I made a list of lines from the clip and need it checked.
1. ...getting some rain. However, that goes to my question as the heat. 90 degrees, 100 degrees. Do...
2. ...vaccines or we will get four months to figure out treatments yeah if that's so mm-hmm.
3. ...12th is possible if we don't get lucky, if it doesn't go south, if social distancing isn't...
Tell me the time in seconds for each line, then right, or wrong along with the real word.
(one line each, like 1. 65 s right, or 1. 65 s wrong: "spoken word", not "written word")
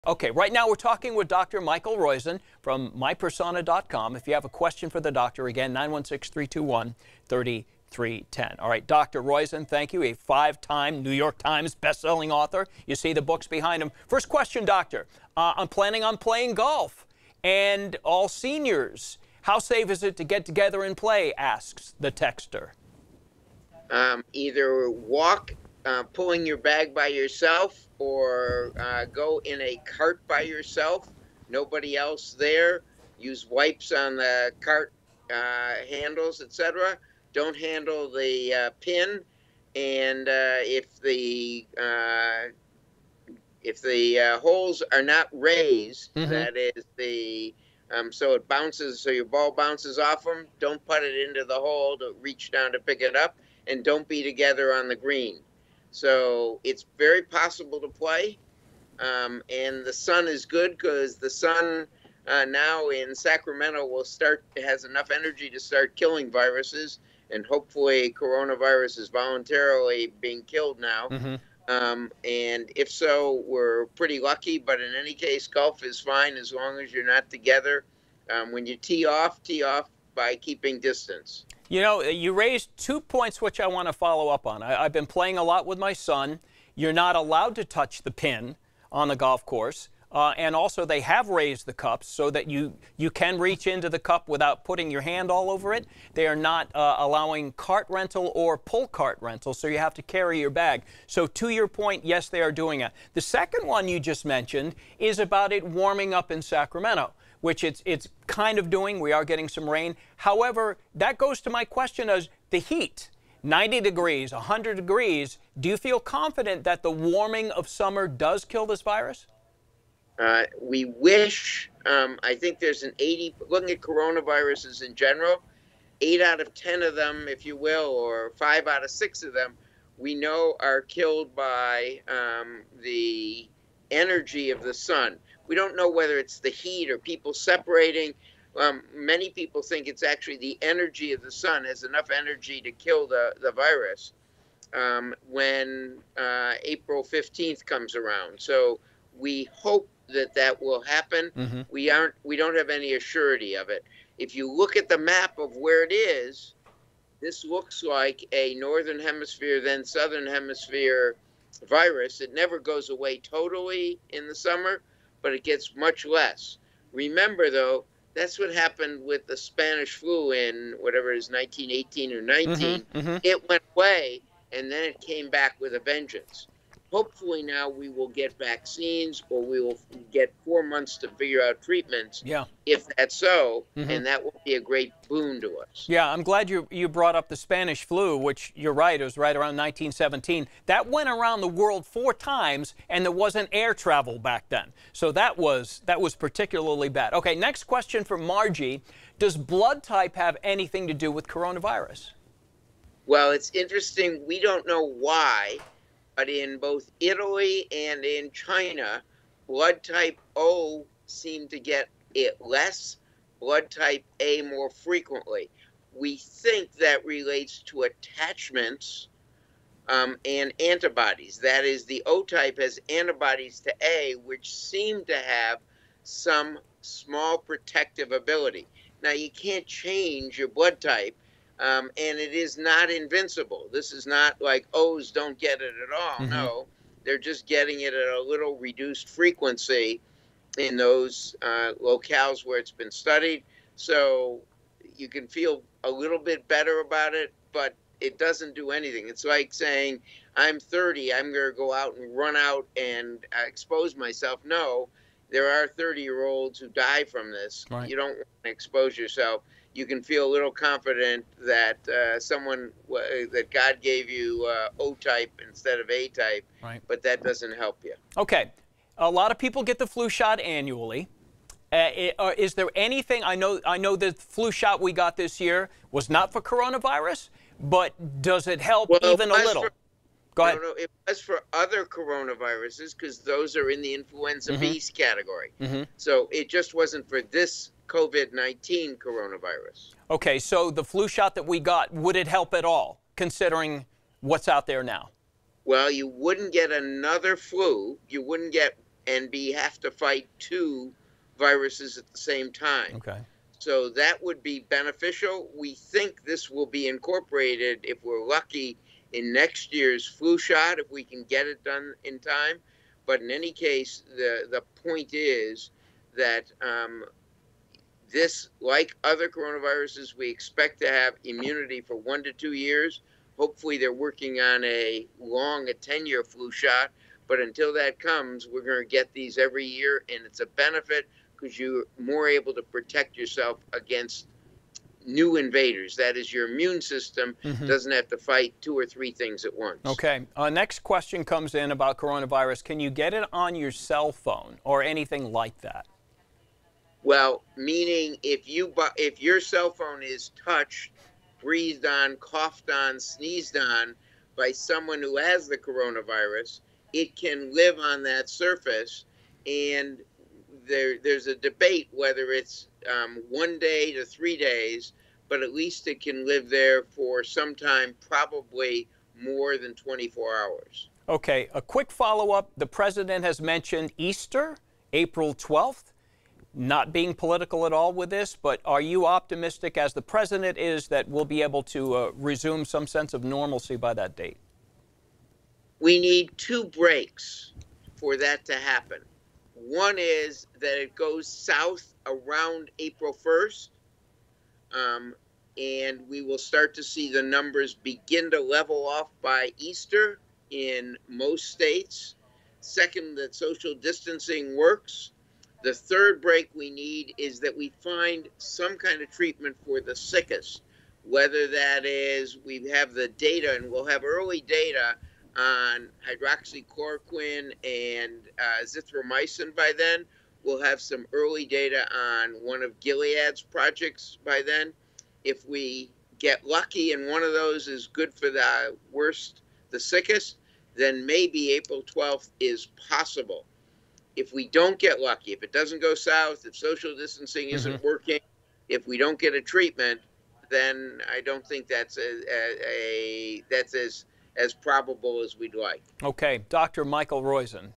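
1. 109 s right
2. 178 s right
3. 431 s right.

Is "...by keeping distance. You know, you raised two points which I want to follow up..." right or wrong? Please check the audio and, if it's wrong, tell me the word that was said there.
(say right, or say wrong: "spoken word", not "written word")
right.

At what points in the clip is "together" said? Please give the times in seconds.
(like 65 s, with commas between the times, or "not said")
20 s, 54 s, 77 s.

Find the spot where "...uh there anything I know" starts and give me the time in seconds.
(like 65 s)
272 s.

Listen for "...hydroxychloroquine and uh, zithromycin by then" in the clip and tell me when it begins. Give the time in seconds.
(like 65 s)
416 s.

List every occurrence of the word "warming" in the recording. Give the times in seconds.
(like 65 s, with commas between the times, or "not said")
105 s, 116 s.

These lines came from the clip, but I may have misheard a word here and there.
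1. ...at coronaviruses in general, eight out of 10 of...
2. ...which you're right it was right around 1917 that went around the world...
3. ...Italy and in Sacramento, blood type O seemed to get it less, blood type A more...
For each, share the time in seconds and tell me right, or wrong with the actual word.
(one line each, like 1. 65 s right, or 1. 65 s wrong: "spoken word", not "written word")
1. 123 s right
2. 188 s right
3. 206 s wrong: "China", not "Sacramento".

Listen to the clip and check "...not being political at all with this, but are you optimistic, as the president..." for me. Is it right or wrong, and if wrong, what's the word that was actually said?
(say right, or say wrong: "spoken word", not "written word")
right.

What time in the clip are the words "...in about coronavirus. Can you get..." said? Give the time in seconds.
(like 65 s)
341 s.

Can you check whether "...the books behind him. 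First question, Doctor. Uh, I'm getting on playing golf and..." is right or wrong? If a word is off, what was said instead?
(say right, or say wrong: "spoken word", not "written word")
wrong: "planning", not "getting".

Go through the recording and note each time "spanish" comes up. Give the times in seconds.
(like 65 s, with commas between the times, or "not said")
169 s, 187 s.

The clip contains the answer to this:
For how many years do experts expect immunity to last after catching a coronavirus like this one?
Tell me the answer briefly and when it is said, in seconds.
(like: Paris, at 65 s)
1 to 2 years, at 321 s.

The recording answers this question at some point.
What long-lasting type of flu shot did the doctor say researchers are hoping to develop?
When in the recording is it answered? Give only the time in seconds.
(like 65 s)
325 s.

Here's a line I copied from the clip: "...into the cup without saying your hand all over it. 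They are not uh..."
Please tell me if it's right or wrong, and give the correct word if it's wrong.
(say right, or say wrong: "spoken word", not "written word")
wrong: "putting", not "saying".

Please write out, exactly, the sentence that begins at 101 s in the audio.
So, to your point, yes, they are doing it.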